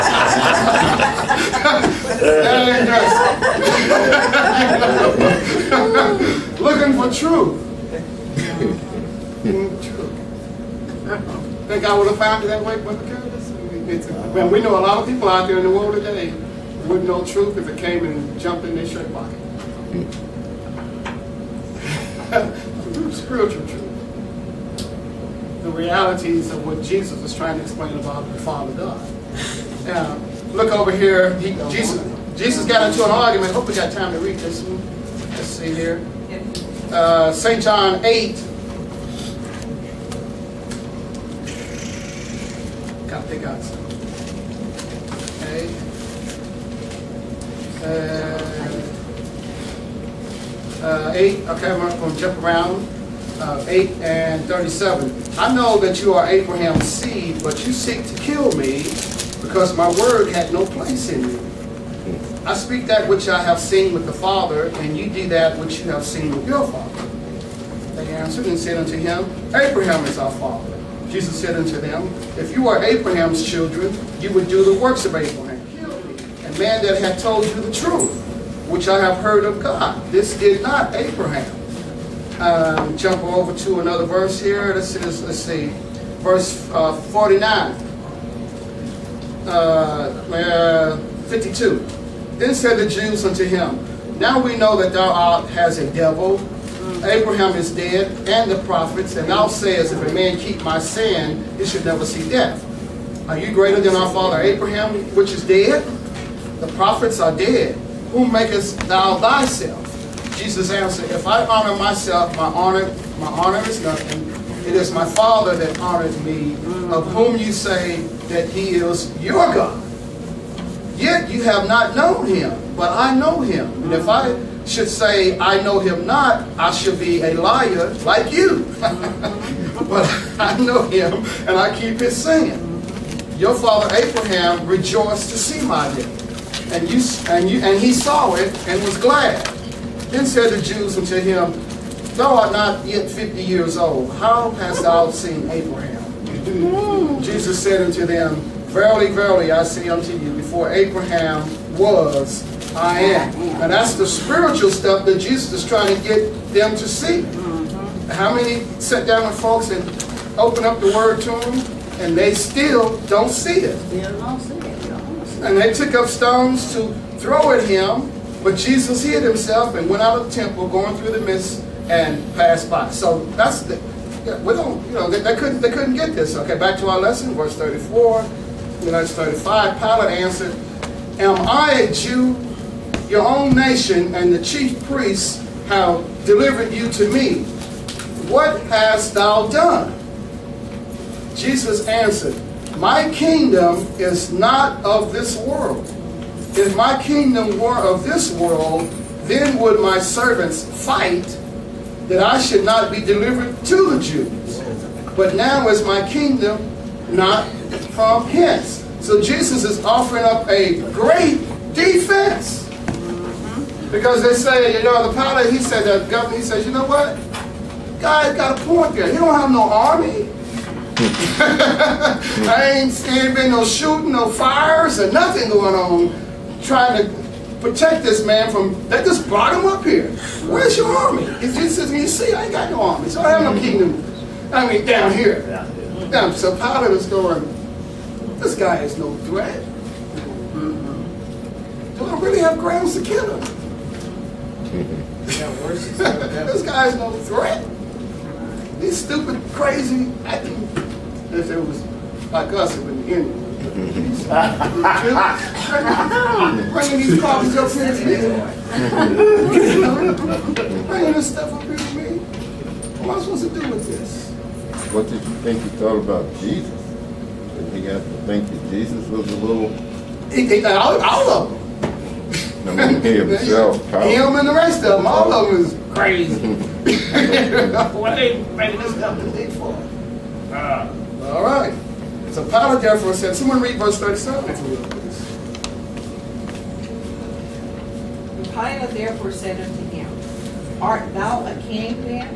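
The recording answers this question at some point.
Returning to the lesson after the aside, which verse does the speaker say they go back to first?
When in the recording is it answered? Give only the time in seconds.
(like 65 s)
177 s.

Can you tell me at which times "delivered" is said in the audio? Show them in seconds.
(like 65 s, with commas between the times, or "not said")
186 s, 203 s.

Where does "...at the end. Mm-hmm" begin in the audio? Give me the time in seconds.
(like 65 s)
252 s.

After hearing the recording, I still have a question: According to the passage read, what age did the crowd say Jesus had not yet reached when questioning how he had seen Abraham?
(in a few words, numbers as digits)
50.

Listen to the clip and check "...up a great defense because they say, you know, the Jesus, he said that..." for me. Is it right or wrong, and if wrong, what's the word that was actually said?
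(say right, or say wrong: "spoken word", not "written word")
wrong: "Pilate", not "Jesus".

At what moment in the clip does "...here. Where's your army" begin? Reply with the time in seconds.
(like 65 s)
229 s.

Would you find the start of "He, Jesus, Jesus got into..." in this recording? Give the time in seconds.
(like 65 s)
31 s.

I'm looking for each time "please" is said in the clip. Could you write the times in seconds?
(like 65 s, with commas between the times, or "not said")
284 s.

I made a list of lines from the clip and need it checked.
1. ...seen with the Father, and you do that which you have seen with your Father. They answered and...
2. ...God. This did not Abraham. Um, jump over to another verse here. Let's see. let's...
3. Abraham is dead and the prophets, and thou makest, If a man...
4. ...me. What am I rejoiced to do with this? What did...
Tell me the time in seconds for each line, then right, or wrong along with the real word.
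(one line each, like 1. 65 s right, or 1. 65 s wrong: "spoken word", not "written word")
1. 63 s right
2. 79 s right
3. 97 s wrong: "sayest", not "makest"
4. 261 s wrong: "supposed", not "rejoiced".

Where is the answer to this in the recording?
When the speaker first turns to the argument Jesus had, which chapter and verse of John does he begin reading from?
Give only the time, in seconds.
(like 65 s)
53 s.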